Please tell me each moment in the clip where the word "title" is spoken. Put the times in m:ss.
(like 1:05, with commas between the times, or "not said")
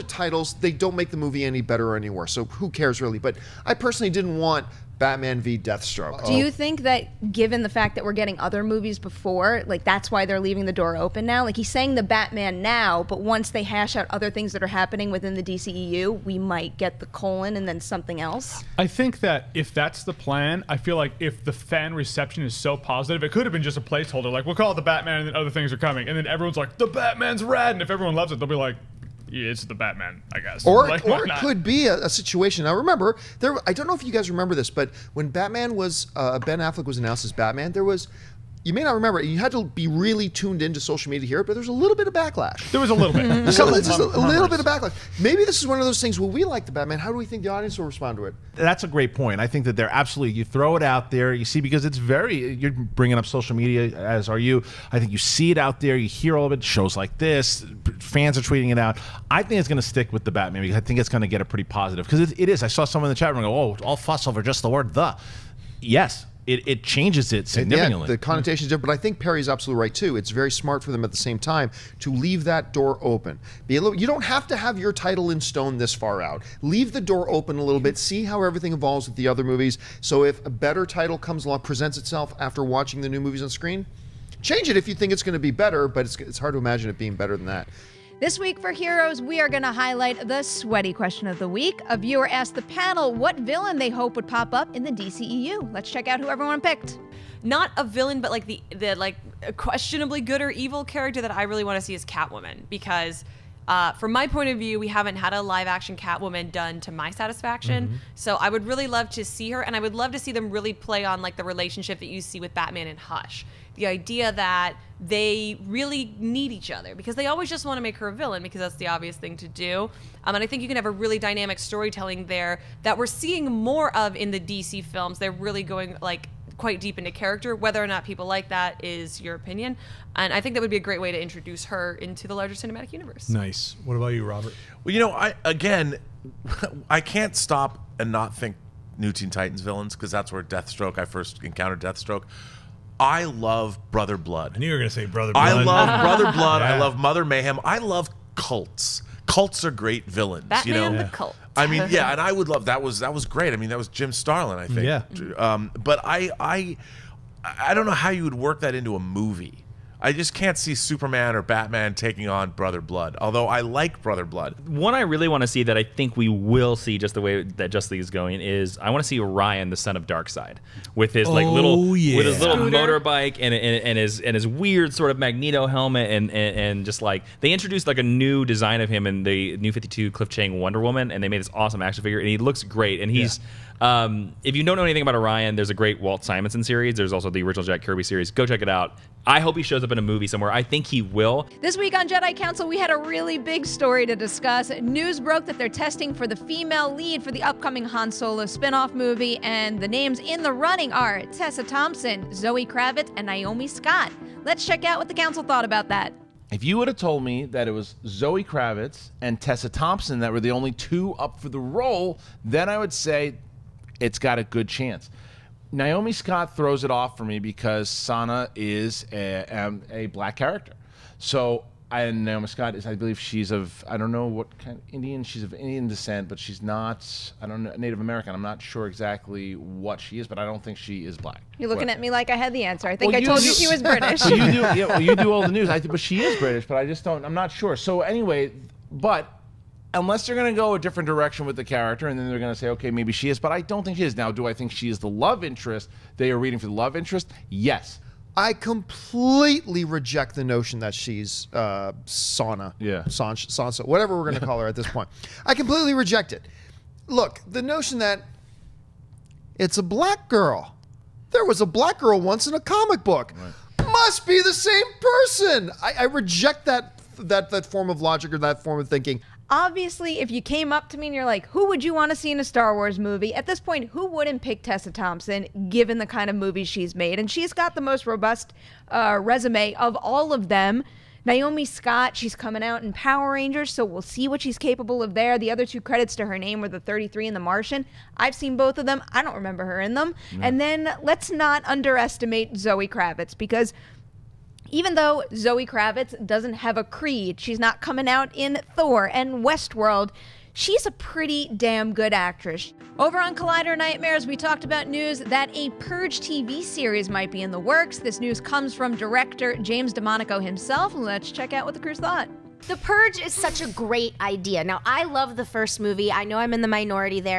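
0:00, 1:14, 1:20.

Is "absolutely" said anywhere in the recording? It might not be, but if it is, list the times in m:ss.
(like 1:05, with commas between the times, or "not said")
0:49, 1:09.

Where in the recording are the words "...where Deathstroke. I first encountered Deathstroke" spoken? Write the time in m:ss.
2:20.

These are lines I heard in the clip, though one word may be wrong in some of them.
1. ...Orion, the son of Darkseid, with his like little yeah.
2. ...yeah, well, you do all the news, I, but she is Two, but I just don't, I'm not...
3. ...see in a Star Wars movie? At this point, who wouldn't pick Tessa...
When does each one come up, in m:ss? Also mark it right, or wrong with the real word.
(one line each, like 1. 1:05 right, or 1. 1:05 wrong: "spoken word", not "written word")
1. 2:49 right
2. 3:54 wrong: "British", not "Two"
3. 4:32 right.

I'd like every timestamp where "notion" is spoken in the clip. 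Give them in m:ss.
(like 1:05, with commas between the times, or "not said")
4:10, 4:17.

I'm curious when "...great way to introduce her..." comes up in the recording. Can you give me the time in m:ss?
2:10.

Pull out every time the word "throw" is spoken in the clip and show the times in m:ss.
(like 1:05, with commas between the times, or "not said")
0:50, 3:36.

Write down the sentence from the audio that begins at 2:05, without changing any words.
They're really going like quite deep into character.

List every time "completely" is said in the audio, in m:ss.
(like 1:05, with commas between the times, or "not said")
4:08, 4:15.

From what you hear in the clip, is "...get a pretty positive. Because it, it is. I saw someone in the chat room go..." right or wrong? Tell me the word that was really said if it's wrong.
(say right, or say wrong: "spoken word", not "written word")
right.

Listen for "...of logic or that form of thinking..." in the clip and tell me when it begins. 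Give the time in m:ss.
4:27.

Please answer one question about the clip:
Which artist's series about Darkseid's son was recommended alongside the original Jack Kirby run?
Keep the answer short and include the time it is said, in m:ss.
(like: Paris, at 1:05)
Walt Simonson, at 3:05.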